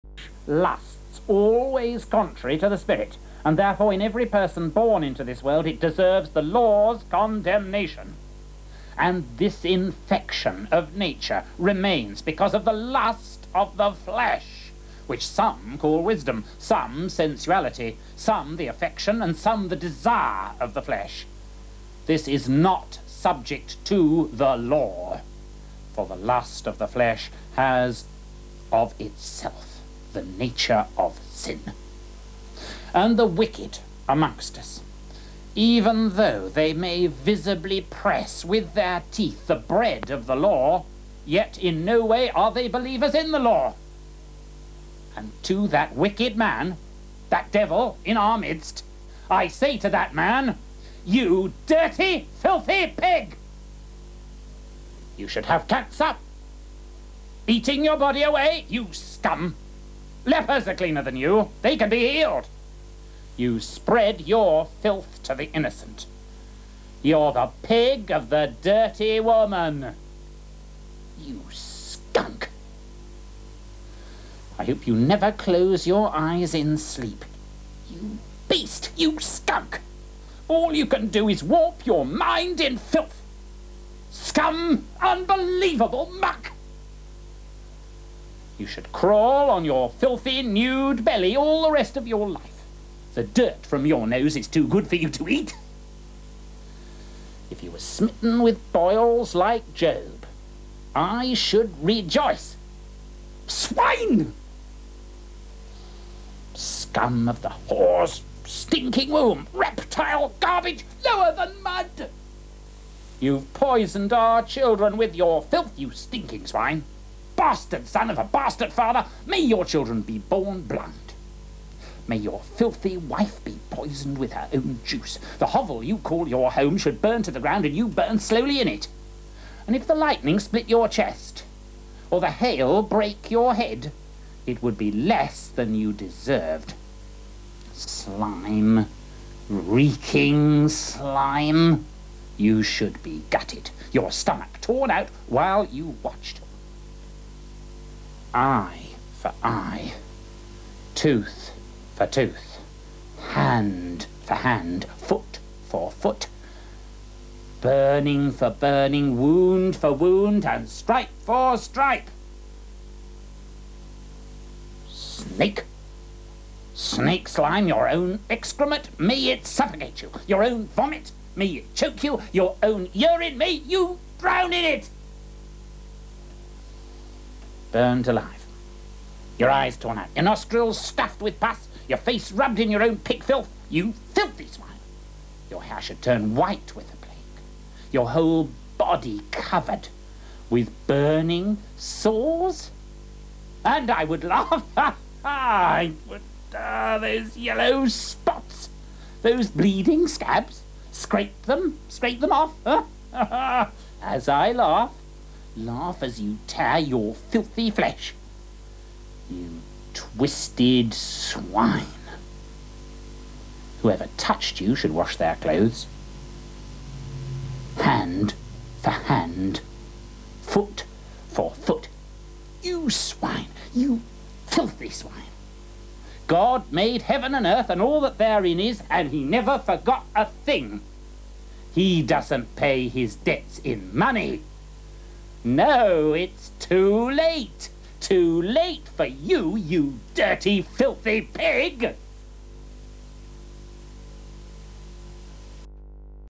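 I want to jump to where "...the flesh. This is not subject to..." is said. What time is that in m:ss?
0:20.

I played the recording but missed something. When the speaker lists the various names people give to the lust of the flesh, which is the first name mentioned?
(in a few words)
wisdom.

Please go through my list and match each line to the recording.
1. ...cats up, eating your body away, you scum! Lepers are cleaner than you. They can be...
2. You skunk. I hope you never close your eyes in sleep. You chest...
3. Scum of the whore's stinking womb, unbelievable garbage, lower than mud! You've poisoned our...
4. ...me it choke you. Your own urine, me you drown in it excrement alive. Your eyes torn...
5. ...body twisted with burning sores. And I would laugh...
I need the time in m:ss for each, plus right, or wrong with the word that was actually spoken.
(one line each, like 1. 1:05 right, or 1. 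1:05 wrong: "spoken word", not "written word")
1. 0:55 right
2. 1:11 wrong: "beast", not "chest"
3. 1:46 wrong: "reptile", not "unbelievable"
4. 2:51 wrong: "burnt", not "excrement"
5. 3:08 wrong: "covered", not "twisted".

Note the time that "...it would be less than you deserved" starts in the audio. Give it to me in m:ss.
2:14.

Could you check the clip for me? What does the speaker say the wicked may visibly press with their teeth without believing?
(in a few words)
the bread of the law.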